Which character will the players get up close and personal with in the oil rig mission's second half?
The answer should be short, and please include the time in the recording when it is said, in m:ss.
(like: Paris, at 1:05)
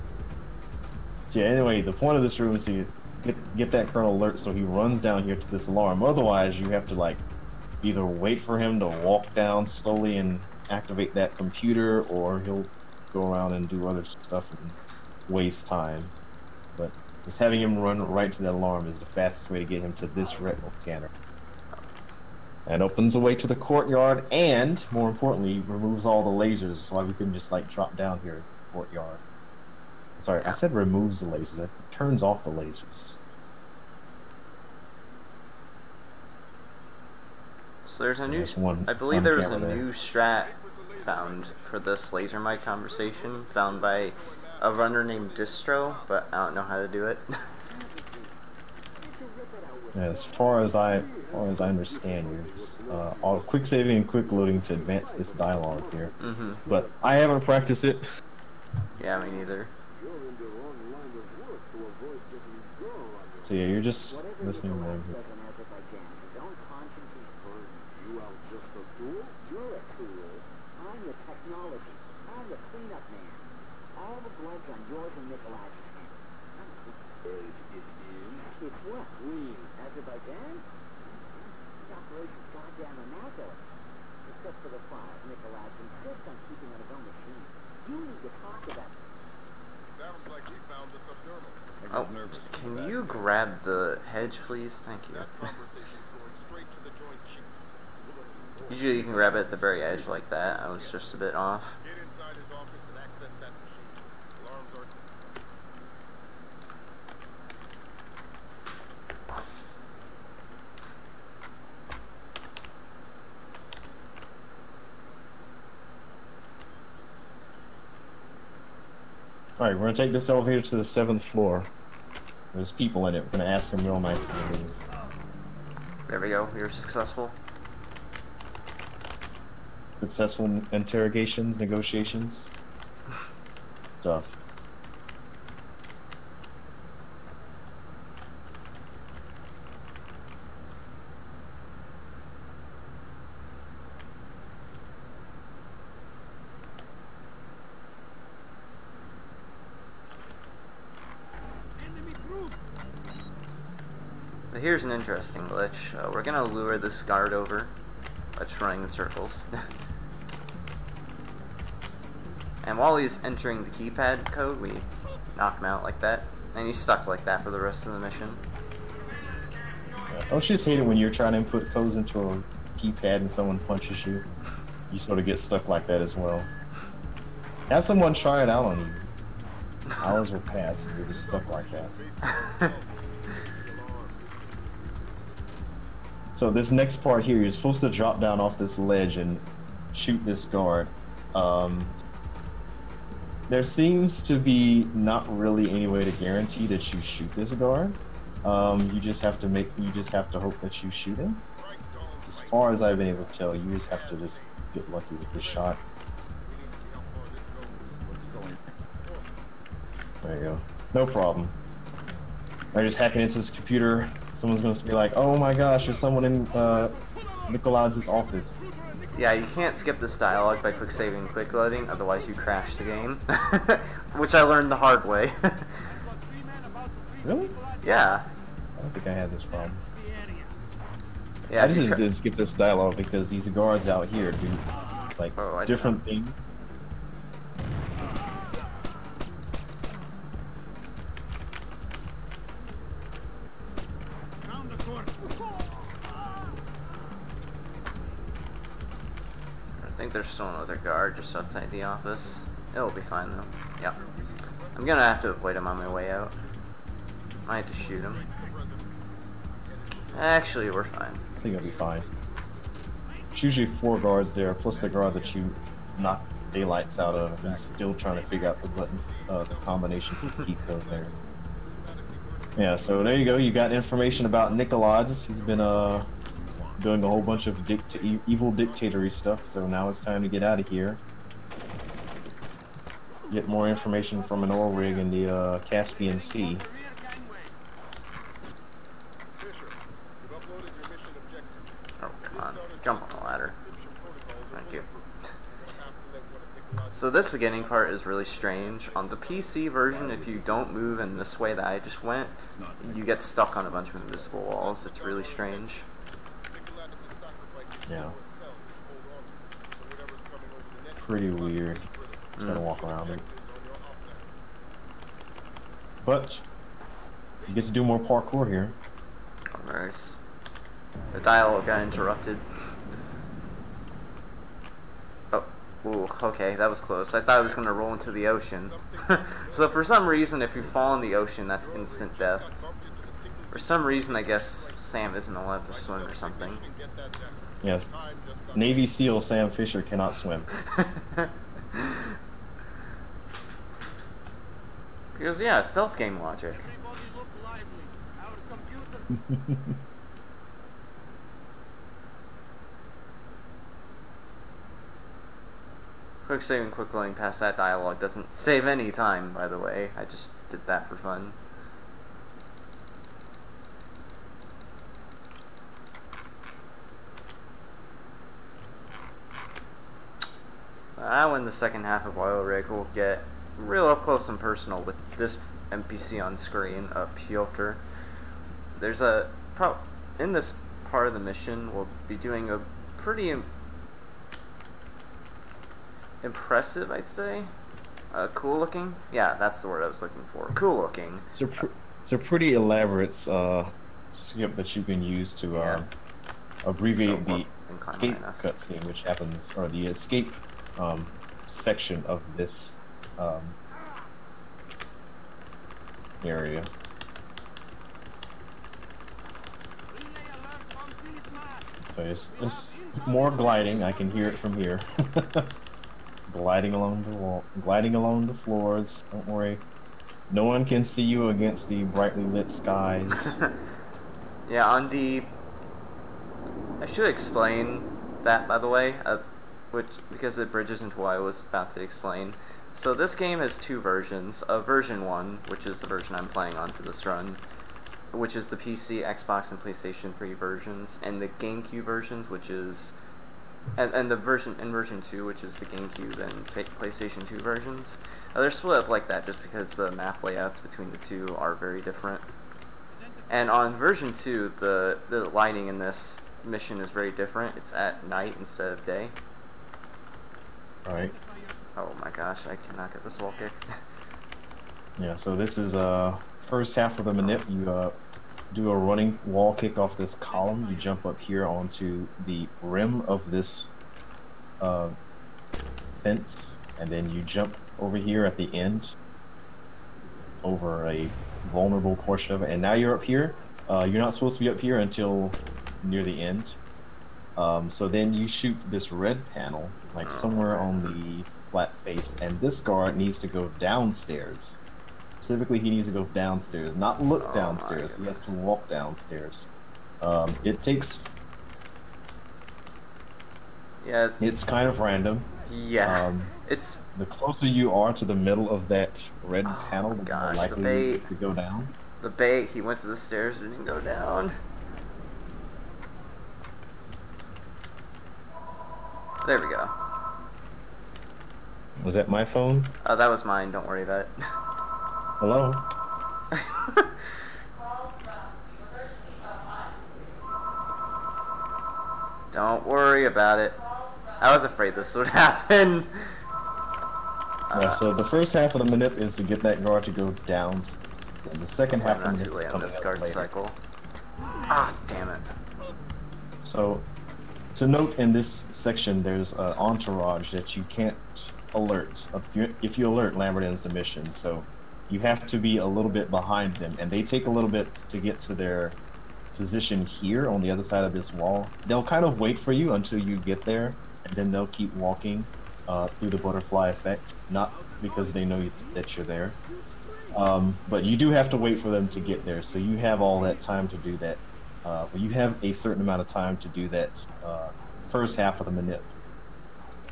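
Piotr, at 6:17.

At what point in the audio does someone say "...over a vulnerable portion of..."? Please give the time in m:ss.
8:00.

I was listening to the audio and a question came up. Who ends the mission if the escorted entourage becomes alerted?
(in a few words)
Lambert.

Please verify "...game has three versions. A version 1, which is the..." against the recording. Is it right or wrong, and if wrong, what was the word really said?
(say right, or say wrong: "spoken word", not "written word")
wrong: "two", not "three".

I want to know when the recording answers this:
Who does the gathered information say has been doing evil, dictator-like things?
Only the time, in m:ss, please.
4:34.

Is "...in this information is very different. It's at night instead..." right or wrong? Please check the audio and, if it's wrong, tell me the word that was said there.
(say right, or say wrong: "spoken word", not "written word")
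wrong: "mission", not "information".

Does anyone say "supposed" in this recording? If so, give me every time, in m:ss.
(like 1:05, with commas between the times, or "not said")
3:07, 8:04.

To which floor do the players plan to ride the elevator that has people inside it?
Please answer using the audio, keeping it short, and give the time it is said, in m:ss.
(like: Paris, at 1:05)
7th floor, at 2:00.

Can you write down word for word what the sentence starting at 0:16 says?
But just having him run right to that alarm is the fastest way to get him to this retinal scanner.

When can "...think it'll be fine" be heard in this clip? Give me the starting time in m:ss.
4:21.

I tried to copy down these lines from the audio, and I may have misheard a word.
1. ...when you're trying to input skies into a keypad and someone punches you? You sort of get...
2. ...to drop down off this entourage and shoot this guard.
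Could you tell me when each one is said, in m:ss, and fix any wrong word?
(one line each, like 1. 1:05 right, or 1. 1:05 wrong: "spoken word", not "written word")
1. 2:50 wrong: "codes", not "skies"
2. 3:07 wrong: "ledge", not "entourage".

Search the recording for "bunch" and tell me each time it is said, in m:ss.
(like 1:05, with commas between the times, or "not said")
4:37, 5:03.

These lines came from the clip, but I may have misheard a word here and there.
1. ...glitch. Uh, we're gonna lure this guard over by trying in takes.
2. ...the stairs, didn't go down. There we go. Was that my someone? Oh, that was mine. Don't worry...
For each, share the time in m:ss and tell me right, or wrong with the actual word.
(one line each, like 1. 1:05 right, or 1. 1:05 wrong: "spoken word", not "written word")
1. 2:35 wrong: "circles", not "takes"
2. 8:32 wrong: "phone", not "someone".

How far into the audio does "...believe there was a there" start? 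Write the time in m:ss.
0:38.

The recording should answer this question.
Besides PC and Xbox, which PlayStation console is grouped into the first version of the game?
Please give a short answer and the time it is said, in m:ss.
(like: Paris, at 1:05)
PlayStation 3, at 7:19.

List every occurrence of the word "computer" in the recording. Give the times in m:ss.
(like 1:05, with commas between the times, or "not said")
0:11, 3:33.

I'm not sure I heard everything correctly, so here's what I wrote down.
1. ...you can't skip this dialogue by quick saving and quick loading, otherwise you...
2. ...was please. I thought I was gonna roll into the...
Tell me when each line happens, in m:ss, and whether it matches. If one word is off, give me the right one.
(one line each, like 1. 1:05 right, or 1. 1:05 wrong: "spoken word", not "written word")
1. 3:39 right
2. 5:26 wrong: "close", not "please".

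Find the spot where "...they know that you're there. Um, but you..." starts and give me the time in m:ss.
9:28.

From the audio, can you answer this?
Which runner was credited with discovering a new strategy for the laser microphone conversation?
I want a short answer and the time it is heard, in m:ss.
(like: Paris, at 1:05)
Distro, at 0:45.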